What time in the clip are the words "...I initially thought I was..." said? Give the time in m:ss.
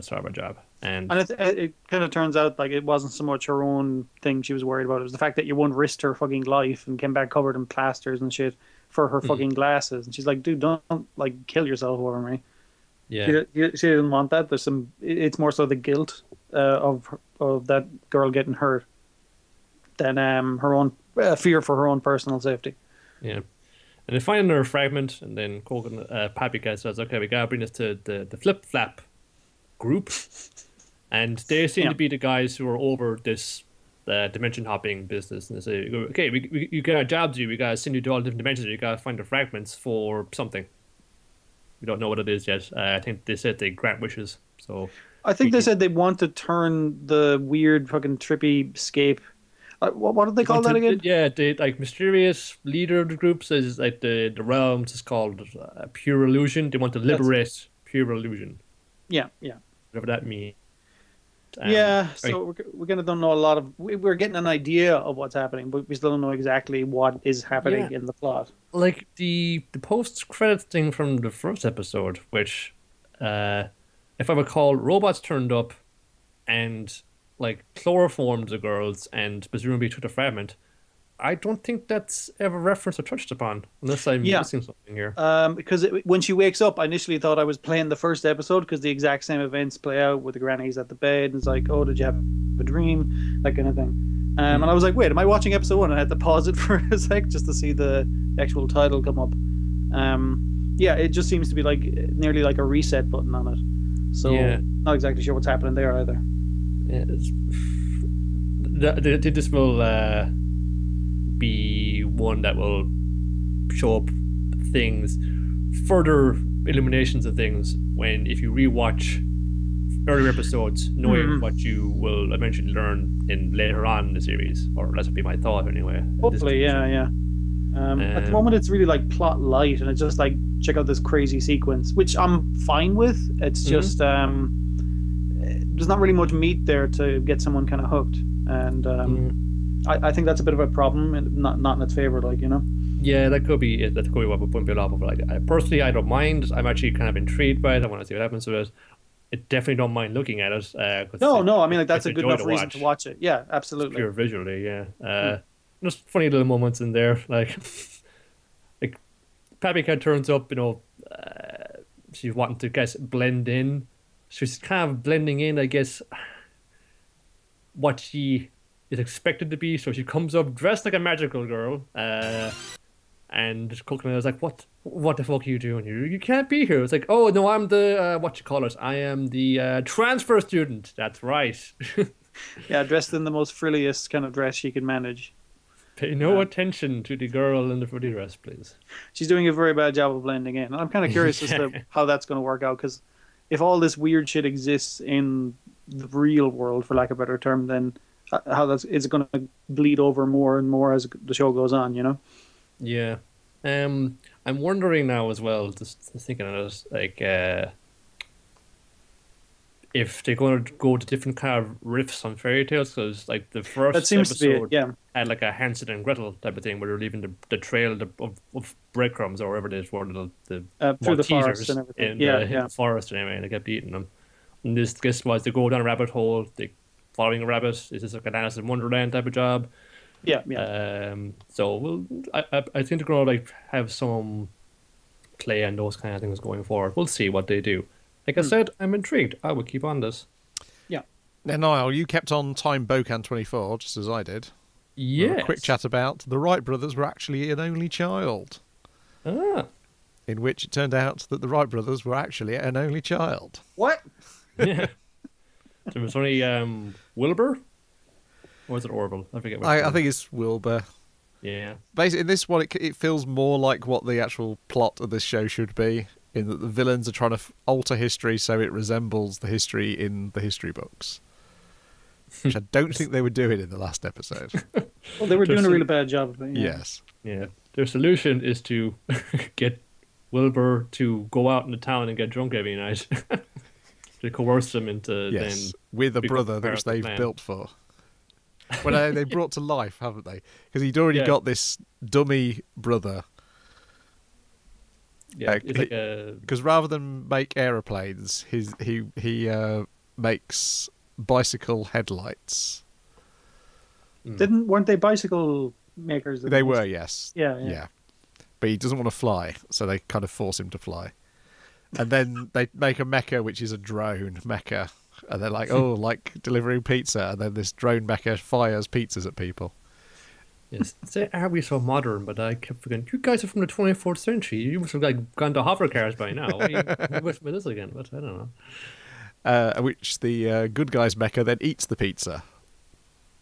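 1:26.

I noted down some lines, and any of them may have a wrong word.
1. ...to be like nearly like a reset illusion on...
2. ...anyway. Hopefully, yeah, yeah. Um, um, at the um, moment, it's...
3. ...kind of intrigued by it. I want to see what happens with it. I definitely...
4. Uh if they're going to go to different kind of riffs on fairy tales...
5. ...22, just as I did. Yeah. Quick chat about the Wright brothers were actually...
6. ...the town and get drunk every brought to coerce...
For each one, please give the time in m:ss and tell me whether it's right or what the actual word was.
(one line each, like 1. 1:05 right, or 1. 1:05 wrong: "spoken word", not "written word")
1. 1:41 wrong: "button", not "illusion"
2. 2:05 right
3. 2:26 right
4. 3:27 right
5. 4:03 wrong: "24", not "22"
6. 4:41 wrong: "night", not "brought".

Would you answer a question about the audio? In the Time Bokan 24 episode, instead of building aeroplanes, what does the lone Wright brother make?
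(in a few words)
Bicycle headlights.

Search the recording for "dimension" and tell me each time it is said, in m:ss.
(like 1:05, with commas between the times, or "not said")
0:34, 0:38.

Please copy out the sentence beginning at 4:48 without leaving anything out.
Well, they brought to life, haven't they?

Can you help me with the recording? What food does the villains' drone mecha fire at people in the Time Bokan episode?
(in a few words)
Pizzas.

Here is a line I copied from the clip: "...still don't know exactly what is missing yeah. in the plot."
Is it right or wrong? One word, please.
wrong.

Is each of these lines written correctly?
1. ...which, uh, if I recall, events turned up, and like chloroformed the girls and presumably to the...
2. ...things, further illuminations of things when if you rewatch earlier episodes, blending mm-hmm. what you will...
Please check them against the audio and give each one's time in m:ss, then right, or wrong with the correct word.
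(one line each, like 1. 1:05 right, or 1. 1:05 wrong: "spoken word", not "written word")
1. 1:12 wrong: "robots", not "events"
2. 1:54 wrong: "knowing", not "blending".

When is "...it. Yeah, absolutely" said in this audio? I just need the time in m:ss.
2:33.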